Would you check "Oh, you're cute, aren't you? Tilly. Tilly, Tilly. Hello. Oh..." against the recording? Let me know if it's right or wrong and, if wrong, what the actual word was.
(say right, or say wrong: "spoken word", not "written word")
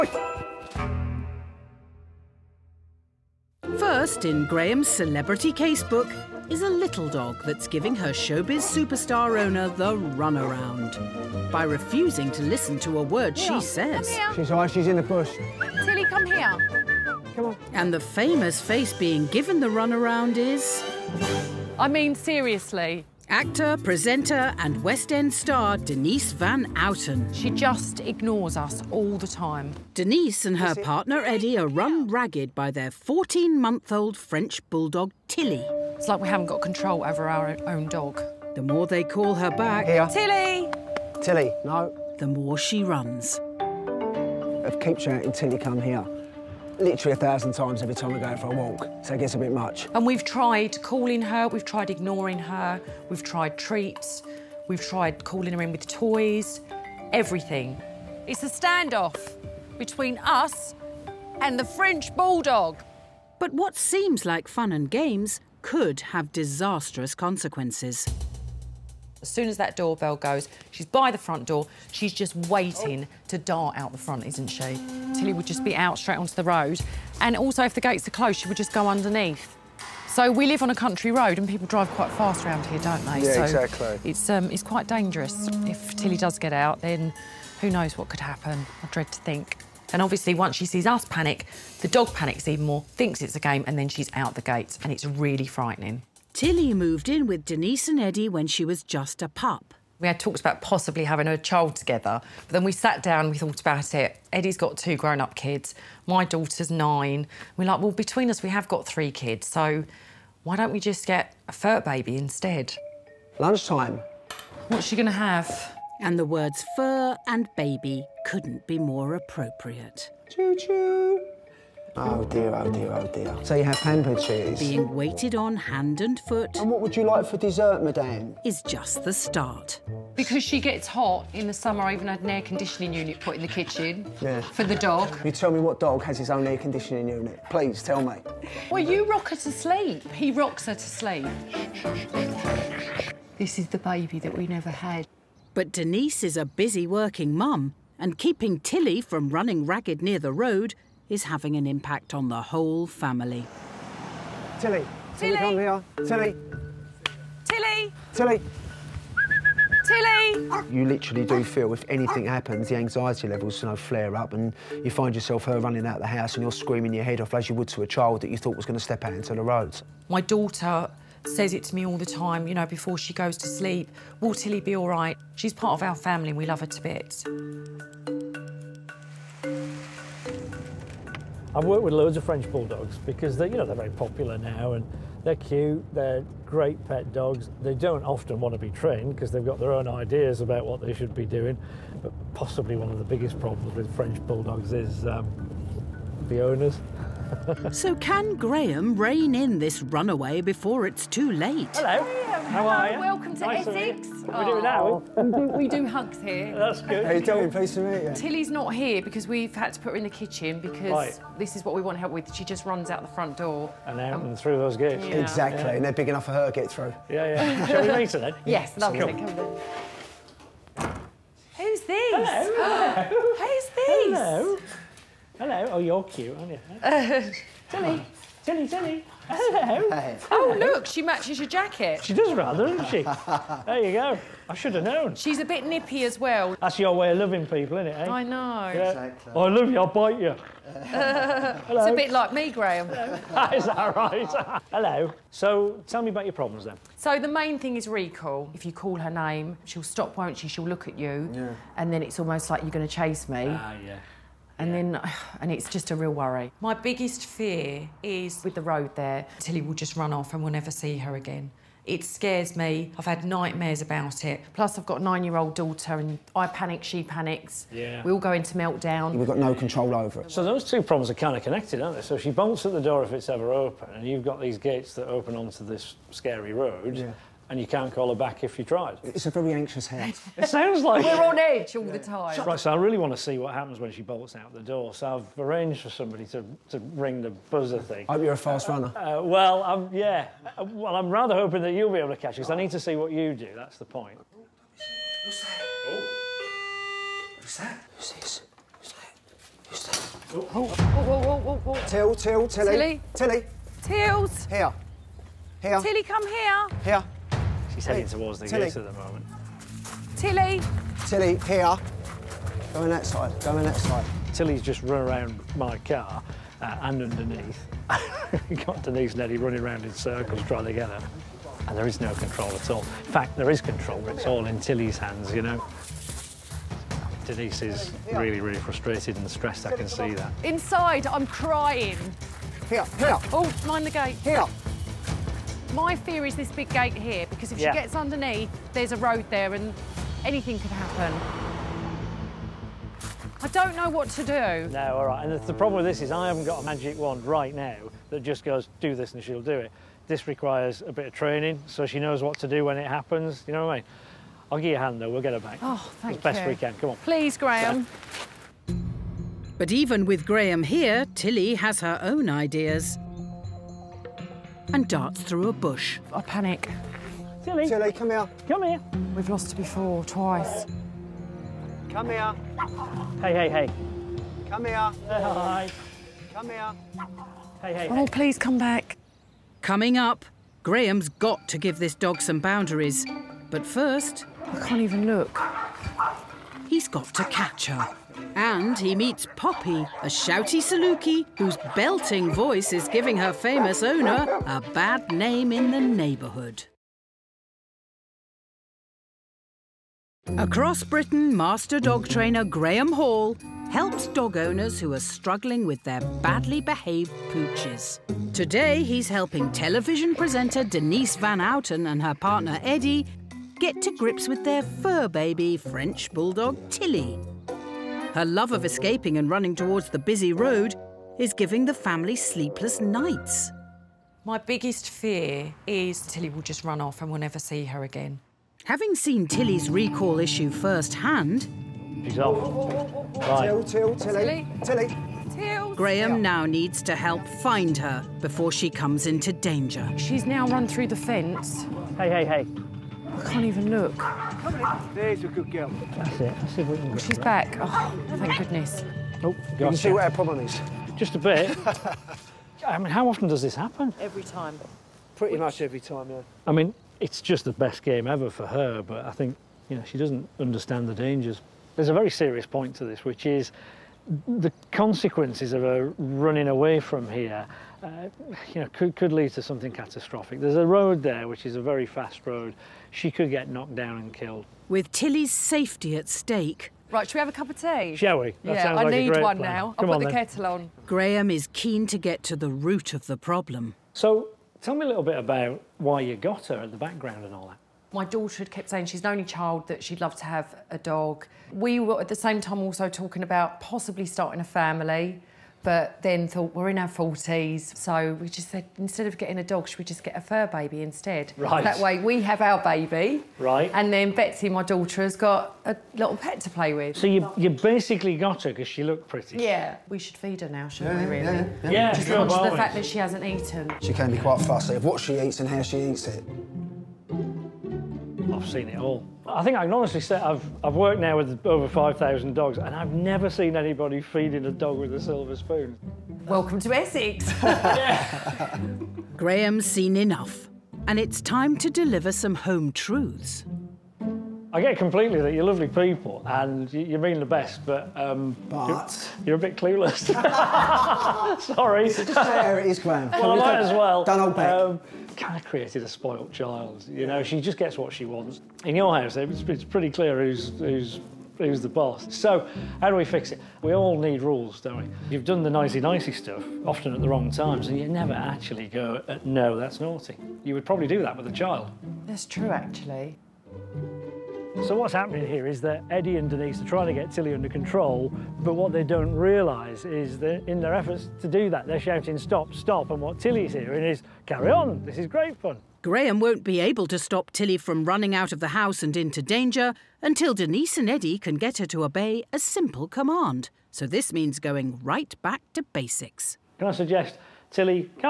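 right.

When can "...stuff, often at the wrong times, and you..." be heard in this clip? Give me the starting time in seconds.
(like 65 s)
556 s.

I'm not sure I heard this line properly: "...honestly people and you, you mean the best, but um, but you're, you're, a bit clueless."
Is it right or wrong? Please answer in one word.
wrong.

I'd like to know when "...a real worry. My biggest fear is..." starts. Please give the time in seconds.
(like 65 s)
255 s.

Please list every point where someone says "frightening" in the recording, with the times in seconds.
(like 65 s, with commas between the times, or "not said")
95 s.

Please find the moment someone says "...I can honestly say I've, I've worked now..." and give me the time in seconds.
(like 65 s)
519 s.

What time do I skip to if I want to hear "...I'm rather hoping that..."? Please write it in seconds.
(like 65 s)
290 s.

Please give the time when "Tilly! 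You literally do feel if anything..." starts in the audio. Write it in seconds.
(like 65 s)
159 s.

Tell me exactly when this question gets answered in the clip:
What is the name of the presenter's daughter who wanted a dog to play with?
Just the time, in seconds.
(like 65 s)
504 s.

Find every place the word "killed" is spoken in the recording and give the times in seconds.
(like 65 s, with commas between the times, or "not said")
474 s.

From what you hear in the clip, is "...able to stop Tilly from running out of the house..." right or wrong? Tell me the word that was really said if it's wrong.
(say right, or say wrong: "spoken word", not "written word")
right.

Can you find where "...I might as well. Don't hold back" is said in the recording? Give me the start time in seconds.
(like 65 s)
543 s.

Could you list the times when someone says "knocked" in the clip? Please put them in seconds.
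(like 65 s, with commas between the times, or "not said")
473 s.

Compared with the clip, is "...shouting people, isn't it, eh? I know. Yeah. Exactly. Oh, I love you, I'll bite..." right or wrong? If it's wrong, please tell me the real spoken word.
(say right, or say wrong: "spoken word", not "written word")
wrong: "loving", not "shouting".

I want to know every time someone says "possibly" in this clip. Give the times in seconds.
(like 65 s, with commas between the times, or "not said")
100 s, 192 s, 493 s.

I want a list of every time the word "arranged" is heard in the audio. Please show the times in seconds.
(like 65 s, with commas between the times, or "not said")
285 s.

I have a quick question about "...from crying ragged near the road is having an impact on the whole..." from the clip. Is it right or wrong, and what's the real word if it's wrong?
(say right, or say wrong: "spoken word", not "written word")
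wrong: "running", not "crying".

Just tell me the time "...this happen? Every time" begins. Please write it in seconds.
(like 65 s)
453 s.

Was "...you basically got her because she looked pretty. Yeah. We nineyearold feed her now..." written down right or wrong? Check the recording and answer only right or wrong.
wrong.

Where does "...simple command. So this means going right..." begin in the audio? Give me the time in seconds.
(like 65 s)
582 s.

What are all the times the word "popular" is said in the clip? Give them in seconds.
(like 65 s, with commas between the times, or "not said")
183 s.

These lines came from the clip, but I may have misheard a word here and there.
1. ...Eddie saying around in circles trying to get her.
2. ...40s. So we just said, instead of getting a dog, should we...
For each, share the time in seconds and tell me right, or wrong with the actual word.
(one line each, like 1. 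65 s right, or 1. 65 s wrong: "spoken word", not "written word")
1. 319 s wrong: "running", not "saying"
2. 496 s right.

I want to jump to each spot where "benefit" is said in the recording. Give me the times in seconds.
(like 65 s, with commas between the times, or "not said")
not said.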